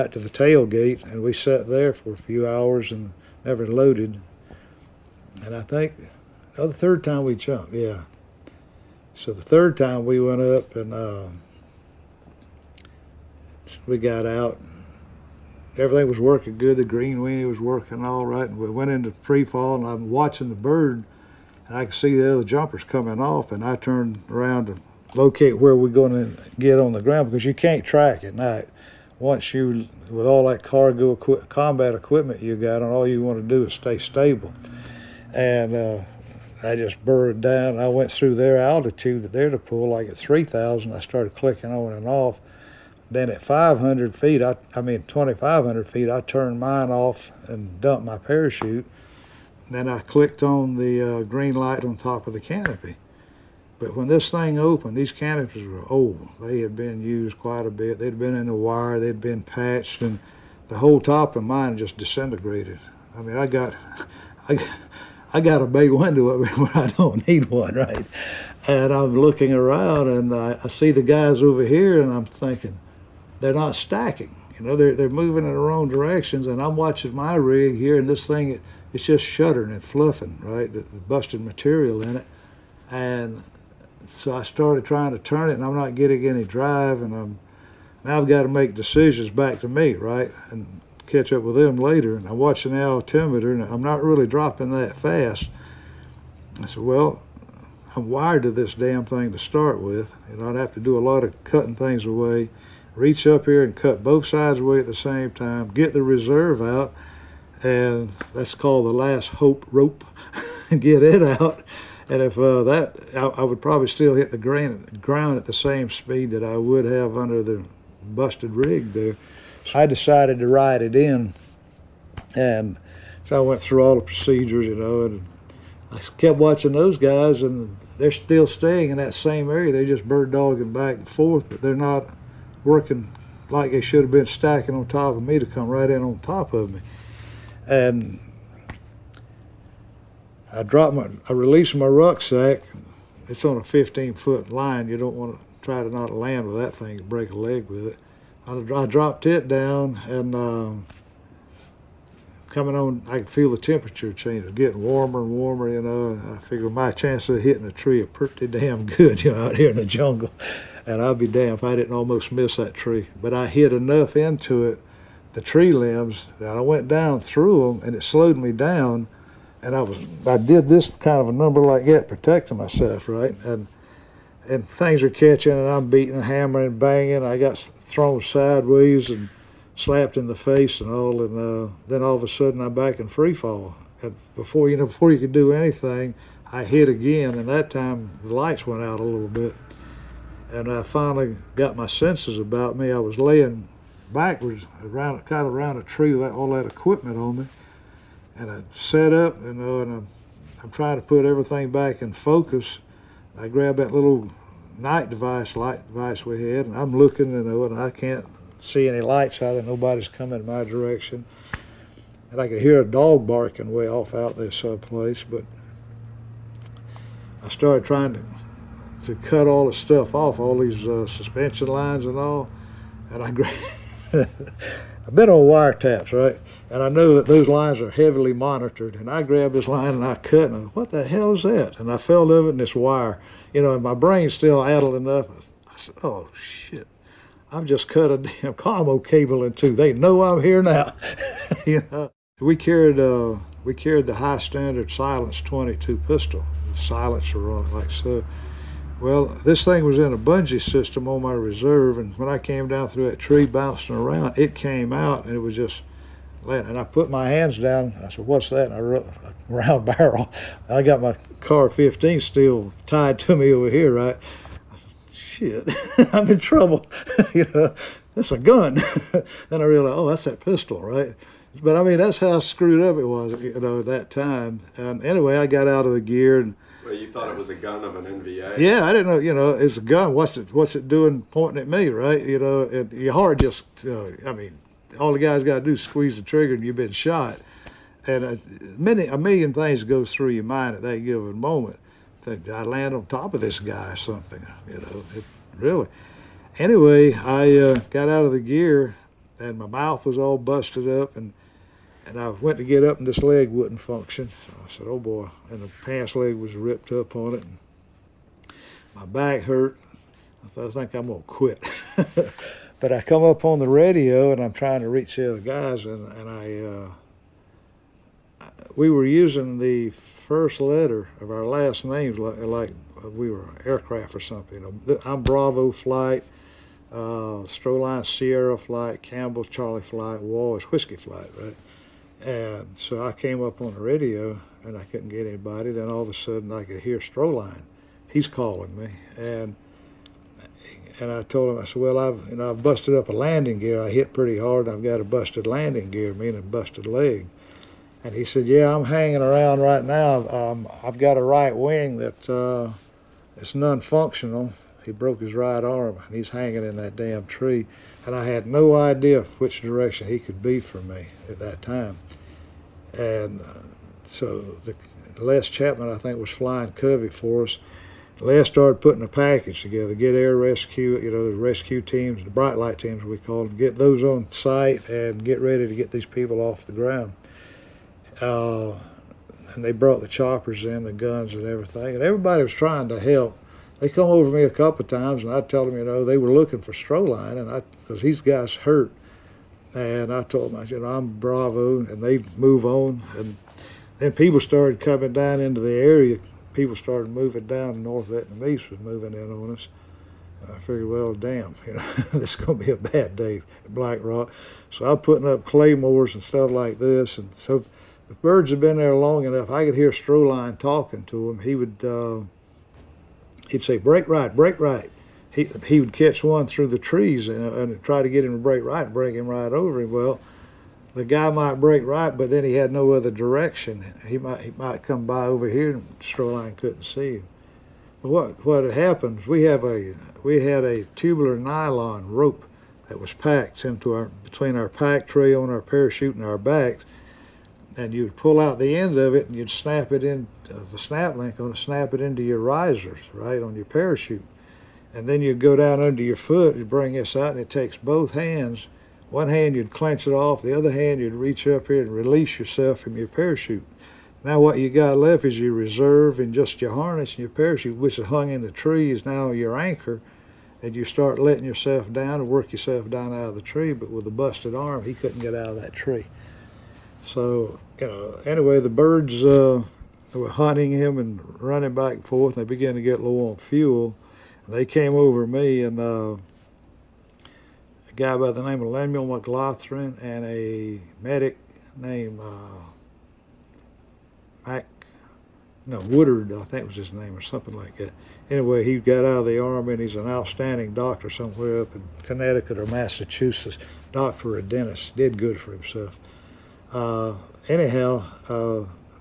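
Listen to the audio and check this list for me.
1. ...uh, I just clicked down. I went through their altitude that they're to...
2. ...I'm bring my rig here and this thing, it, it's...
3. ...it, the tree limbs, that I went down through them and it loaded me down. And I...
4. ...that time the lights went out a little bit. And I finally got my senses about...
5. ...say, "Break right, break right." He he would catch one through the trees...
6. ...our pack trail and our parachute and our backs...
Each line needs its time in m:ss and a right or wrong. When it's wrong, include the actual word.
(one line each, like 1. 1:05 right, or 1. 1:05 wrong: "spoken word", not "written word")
1. 0:35 wrong: "burrowed", not "clicked"
2. 1:16 wrong: "watching", not "bring"
3. 2:44 wrong: "slowed", not "loaded"
4. 3:07 right
5. 6:53 right
6. 7:14 right.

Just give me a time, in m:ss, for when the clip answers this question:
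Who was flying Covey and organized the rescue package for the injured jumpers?
6:05.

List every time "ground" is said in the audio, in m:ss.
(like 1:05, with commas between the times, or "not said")
0:27, 1:54, 6:16.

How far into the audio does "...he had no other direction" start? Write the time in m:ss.
7:02.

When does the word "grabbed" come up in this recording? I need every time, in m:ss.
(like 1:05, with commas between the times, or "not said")
3:23, 3:49.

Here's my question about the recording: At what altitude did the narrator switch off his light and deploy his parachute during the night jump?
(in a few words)
2,500 feet.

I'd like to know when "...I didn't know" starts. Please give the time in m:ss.
4:38.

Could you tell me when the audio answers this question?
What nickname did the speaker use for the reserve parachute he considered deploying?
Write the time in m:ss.
1:48.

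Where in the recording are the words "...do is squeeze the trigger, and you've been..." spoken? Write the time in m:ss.
4:45.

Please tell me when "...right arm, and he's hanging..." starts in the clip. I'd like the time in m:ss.
5:55.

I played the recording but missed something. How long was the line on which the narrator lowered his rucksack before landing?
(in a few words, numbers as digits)
15 foot.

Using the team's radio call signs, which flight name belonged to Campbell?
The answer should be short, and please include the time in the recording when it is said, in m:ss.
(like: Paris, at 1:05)
Charlie Flight, at 5:29.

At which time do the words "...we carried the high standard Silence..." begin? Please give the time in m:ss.
4:03.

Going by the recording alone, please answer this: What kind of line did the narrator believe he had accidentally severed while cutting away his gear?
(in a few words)
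commo cable.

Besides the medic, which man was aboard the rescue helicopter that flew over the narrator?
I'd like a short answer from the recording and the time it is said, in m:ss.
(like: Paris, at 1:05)
Lemuel McLaughlin, at 7:58.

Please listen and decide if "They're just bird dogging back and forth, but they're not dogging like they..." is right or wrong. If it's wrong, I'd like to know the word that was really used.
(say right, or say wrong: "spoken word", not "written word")
wrong: "working", not "dogging".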